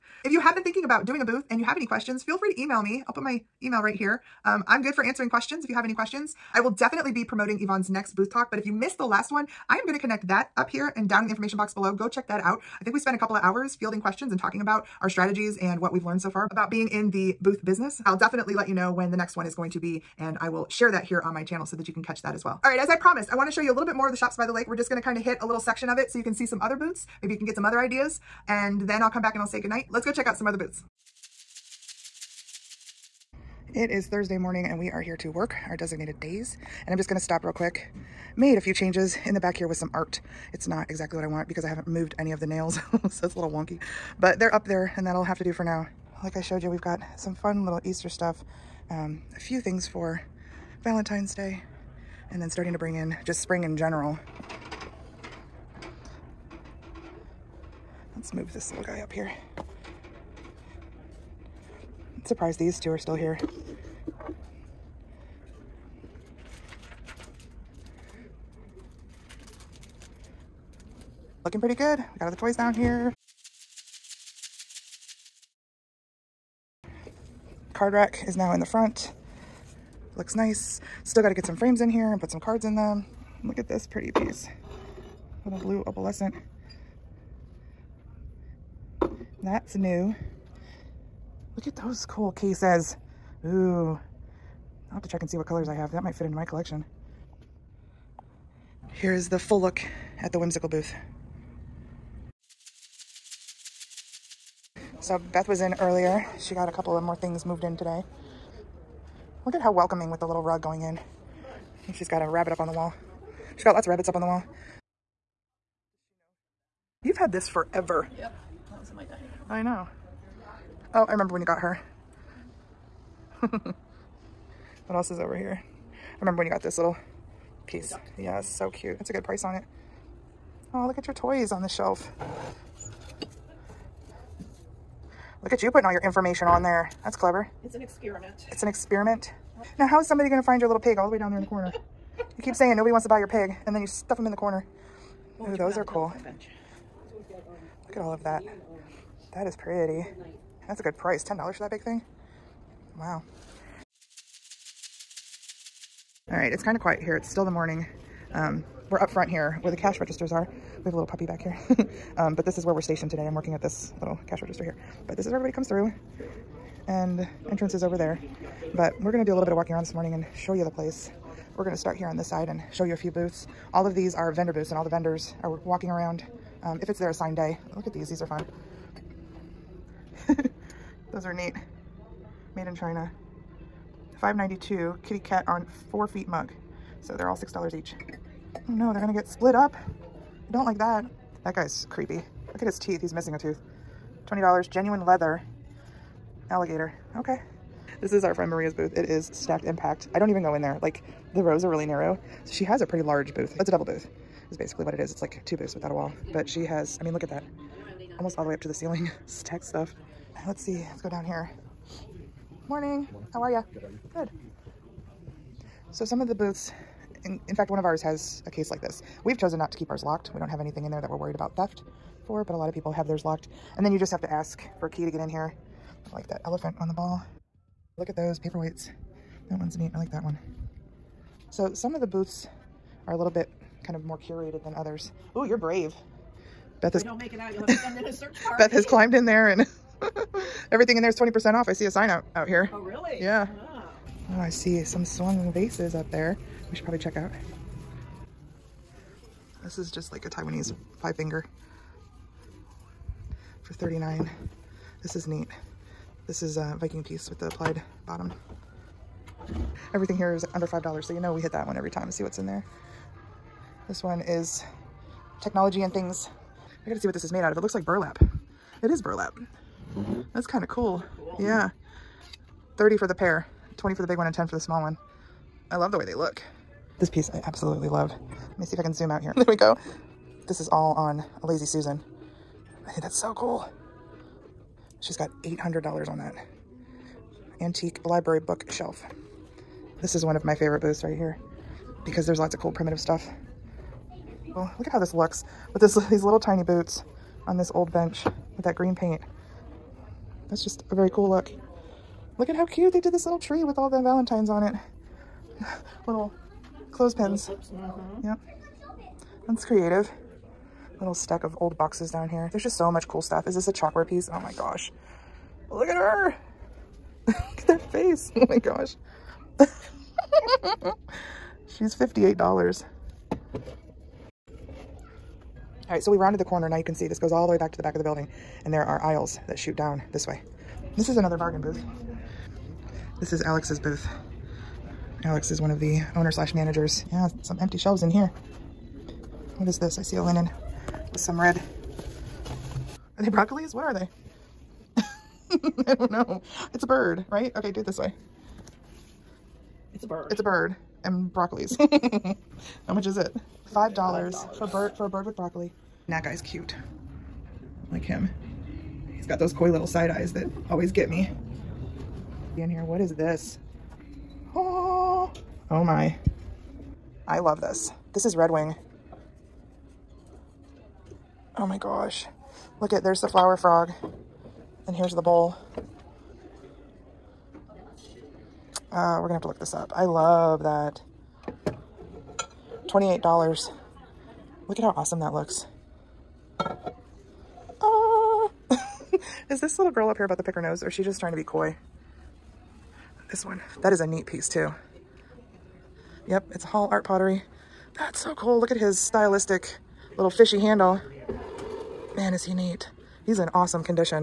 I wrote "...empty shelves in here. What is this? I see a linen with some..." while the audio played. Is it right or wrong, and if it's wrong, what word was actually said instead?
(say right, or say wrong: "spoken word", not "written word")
right.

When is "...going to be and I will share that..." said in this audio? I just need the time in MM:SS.
00:19.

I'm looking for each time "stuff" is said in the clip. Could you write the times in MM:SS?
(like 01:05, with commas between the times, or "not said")
00:48, 02:23, 03:29, 04:52, 05:13.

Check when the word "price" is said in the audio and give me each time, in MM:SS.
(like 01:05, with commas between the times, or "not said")
02:09, 02:30.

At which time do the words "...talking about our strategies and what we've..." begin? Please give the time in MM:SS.
00:14.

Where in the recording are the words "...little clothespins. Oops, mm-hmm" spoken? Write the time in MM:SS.
05:06.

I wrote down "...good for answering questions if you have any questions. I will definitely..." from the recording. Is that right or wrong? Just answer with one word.
right.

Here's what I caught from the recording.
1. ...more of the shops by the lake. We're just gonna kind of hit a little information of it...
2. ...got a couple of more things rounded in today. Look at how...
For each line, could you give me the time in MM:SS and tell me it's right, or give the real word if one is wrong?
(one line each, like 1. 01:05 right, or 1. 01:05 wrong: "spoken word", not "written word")
1. 00:23 wrong: "section", not "information"
2. 01:46 wrong: "moved", not "rounded".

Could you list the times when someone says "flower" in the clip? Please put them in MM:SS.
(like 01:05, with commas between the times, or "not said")
06:13.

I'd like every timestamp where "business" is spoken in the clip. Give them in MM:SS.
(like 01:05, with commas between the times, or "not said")
00:17.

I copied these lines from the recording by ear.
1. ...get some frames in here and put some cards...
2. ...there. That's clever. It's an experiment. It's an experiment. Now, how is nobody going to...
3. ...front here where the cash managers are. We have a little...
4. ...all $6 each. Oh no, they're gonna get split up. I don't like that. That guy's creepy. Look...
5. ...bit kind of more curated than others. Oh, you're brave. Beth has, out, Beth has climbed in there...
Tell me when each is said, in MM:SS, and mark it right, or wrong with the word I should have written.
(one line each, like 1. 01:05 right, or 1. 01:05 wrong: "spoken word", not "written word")
1. 01:21 right
2. 02:16 wrong: "somebody", not "nobody"
3. 02:39 wrong: "registers", not "managers"
4. 03:07 right
5. 03:53 right.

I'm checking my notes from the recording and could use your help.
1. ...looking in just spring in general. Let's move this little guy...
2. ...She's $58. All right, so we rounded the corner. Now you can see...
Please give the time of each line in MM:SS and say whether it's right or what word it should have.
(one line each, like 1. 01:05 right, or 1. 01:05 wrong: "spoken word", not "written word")
1. 00:52 wrong: "bring", not "looking"
2. 05:21 right.